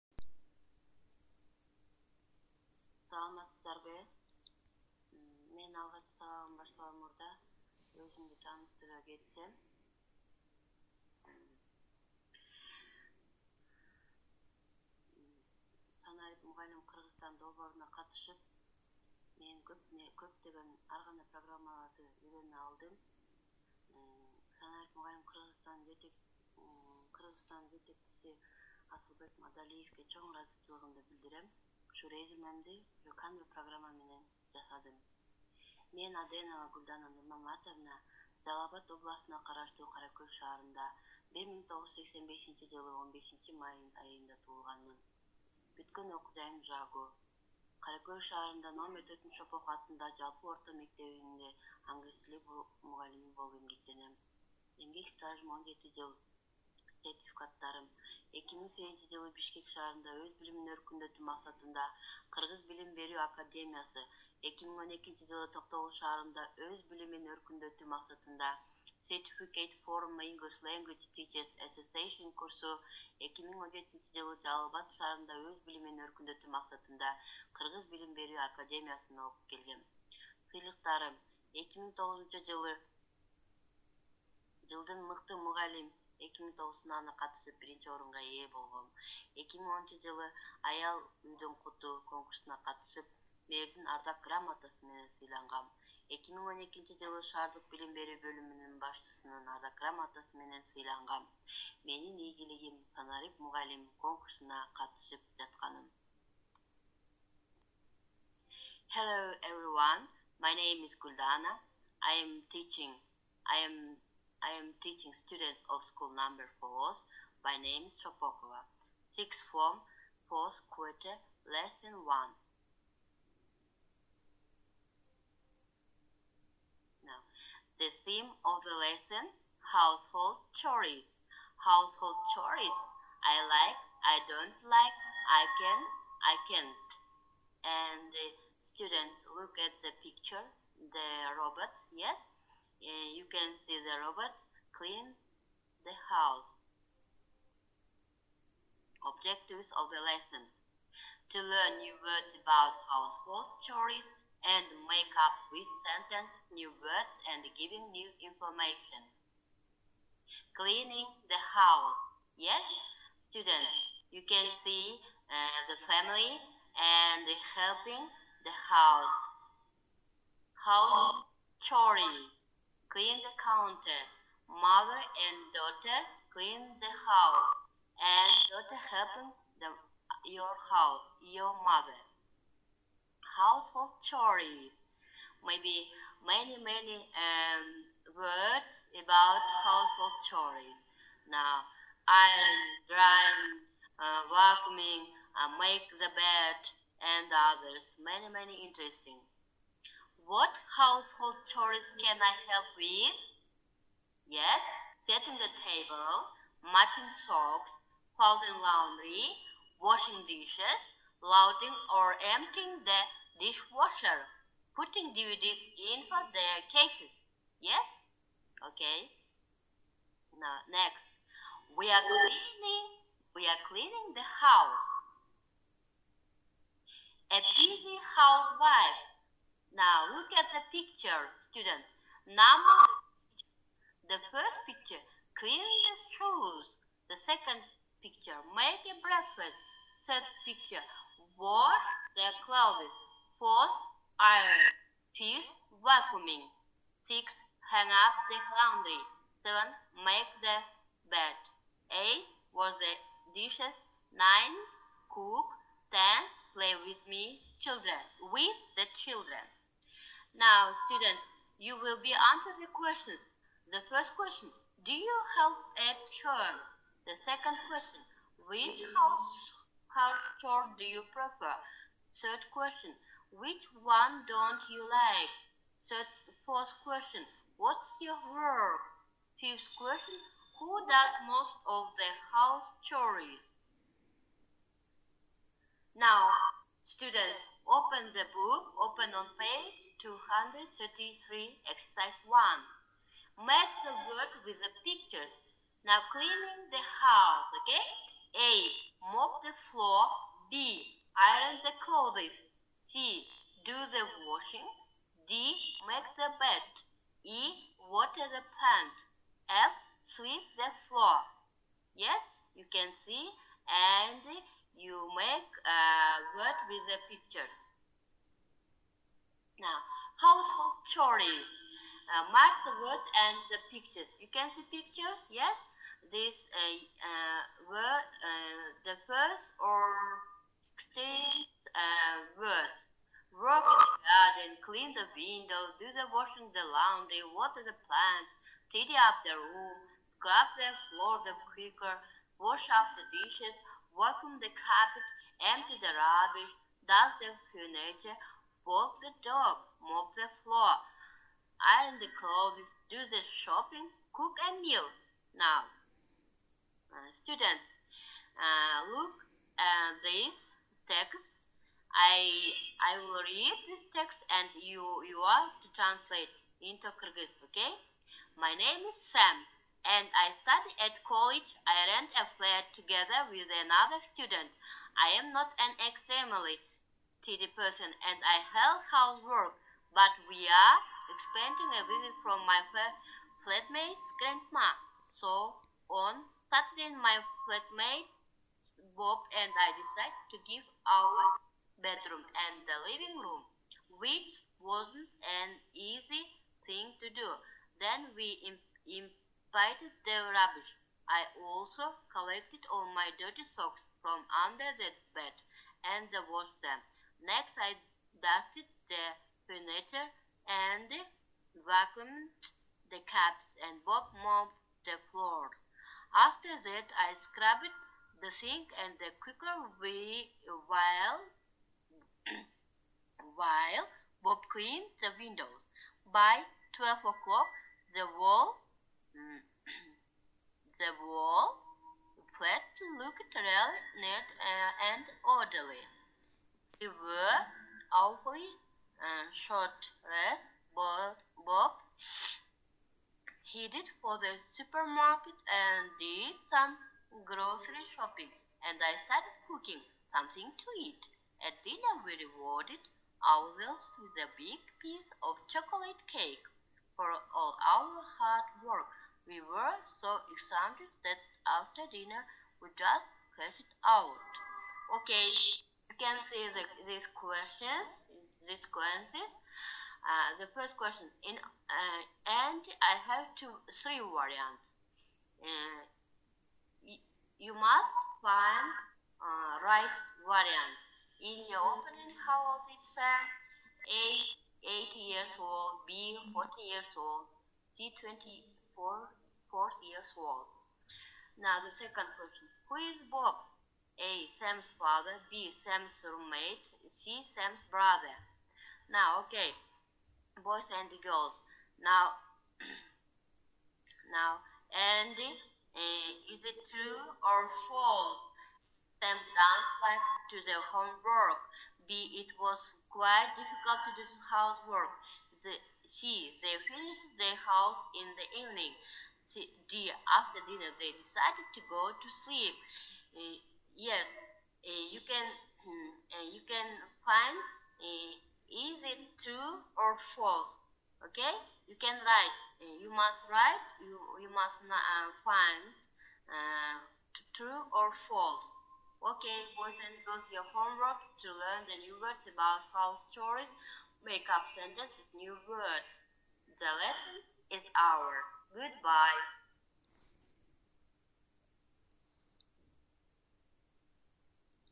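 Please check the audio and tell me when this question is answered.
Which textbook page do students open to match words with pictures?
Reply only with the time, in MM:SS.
04:49.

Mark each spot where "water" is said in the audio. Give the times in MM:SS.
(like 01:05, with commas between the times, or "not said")
05:07, 05:37.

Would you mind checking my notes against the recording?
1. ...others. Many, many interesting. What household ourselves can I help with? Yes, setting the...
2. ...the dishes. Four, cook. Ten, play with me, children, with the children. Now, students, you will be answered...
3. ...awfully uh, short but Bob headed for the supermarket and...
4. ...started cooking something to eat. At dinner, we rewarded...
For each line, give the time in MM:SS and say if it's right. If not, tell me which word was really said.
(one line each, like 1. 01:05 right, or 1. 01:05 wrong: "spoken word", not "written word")
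1. 03:17 wrong: "chores", not "ourselves"
2. 04:12 wrong: "Nine", not "Four"
3. 07:17 right
4. 07:29 right.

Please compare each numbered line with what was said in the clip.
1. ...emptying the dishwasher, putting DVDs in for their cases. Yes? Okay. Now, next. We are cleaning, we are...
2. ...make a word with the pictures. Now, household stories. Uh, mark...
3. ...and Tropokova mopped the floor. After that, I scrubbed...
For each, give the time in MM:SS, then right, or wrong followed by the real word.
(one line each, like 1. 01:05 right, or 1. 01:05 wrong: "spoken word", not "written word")
1. 03:32 right
2. 05:15 wrong: "chores", not "stories"
3. 06:53 wrong: "Bob", not "Tropokova".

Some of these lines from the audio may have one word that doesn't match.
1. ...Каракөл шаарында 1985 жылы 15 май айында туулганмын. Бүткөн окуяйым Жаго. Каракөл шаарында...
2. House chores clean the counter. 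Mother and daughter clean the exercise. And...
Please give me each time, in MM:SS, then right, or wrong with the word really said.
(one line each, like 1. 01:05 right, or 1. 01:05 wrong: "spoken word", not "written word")
1. 00:39 right
2. 02:50 wrong: "house", not "exercise".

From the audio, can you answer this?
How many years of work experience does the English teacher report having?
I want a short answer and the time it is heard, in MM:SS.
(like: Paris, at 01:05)
7, at 00:55.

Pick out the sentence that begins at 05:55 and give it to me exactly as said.
Now, uh, students, uh, look at this text.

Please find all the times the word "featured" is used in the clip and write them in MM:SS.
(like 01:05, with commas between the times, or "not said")
not said.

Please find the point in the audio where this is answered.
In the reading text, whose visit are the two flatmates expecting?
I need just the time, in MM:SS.
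06:24.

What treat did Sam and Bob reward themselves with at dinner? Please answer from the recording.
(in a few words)
Chocolate cake.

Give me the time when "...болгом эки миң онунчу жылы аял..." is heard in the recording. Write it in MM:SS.
01:28.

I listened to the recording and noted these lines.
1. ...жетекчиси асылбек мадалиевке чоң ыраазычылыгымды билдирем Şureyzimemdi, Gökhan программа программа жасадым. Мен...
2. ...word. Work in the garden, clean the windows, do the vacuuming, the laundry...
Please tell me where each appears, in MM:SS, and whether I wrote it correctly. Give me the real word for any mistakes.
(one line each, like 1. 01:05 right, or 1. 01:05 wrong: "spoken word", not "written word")
1. 00:27 right
2. 05:32 wrong: "washing", not "vacuuming".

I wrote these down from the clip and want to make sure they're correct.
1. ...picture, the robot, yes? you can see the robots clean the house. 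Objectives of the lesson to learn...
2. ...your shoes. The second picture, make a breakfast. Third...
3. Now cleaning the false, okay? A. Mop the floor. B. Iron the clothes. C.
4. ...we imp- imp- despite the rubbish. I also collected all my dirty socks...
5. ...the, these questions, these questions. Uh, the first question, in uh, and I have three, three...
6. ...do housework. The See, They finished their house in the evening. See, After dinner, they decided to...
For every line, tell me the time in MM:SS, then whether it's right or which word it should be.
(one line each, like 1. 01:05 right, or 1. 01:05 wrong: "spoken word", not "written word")
1. 02:20 right
2. 03:55 right
3. 04:55 wrong: "house", not "false"
4. 06:38 right
5. 07:46 wrong: "two", not "three"
6. 08:34 right.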